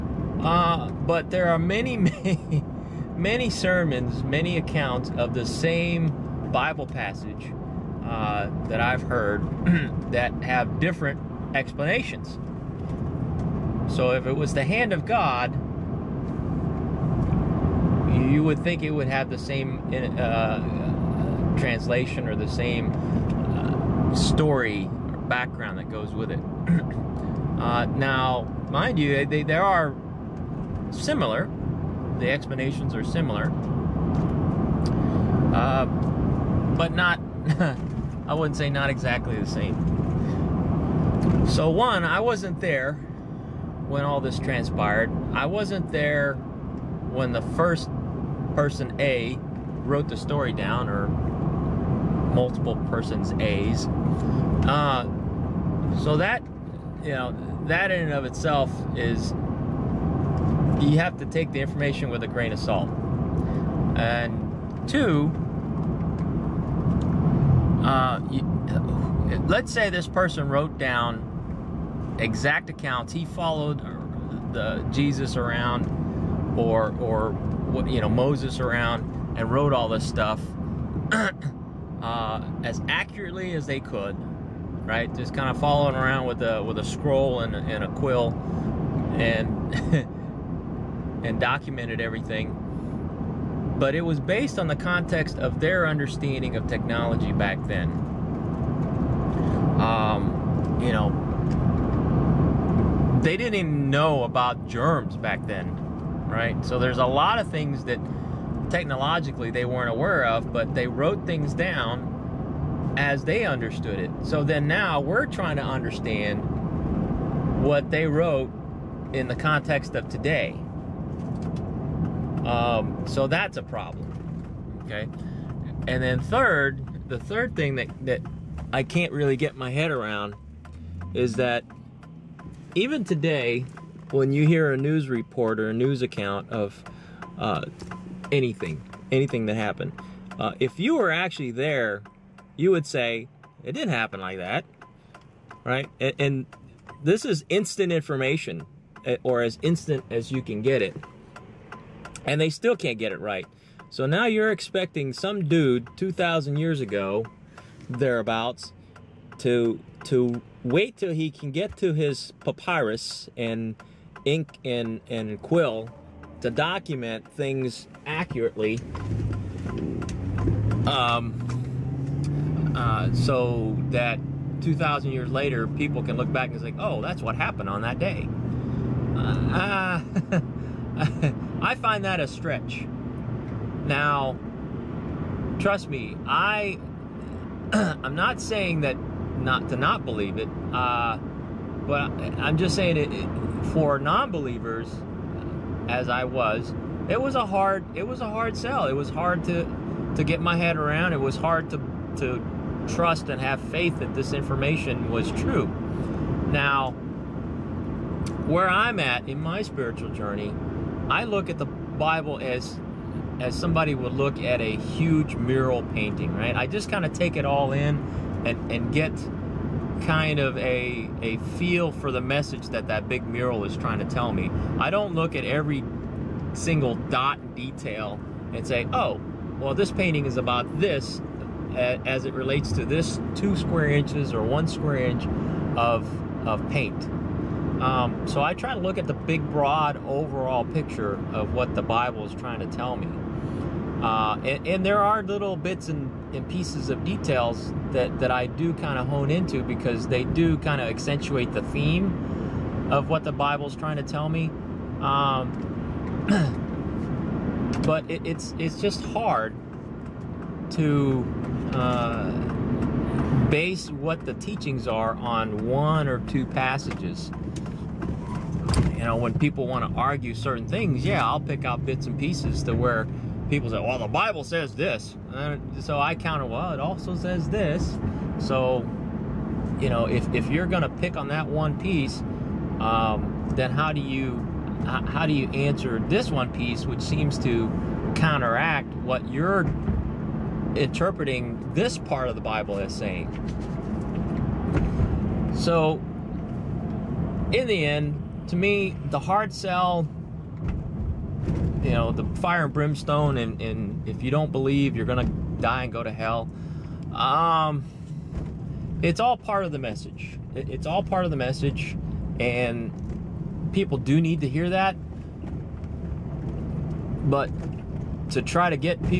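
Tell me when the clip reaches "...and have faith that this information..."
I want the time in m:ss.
3:23.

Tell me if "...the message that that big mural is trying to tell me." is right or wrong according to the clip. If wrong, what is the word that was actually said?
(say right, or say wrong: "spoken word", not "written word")
right.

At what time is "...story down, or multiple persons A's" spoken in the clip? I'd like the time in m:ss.
0:50.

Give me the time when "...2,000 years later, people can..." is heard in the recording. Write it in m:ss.
2:54.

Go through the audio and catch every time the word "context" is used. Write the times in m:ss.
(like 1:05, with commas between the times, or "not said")
1:34, 1:59.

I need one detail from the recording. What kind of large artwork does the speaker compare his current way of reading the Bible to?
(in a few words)
a huge mural painting.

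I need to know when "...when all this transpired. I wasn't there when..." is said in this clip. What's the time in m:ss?
0:43.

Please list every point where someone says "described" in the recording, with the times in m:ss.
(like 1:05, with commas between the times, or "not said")
not said.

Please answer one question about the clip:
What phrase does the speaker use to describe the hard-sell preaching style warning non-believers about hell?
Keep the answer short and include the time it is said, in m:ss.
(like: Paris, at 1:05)
fire and brimstone, at 5:02.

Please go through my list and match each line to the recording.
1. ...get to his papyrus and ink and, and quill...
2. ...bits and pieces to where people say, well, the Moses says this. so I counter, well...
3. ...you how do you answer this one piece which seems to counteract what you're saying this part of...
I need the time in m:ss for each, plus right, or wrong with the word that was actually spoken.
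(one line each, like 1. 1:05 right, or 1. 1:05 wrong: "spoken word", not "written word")
1. 2:41 right
2. 4:31 wrong: "Bible", not "Moses"
3. 4:44 wrong: "interpreting", not "saying".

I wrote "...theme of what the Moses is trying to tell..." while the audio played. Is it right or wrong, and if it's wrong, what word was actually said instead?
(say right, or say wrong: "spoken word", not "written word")
wrong: "Bible", not "Moses".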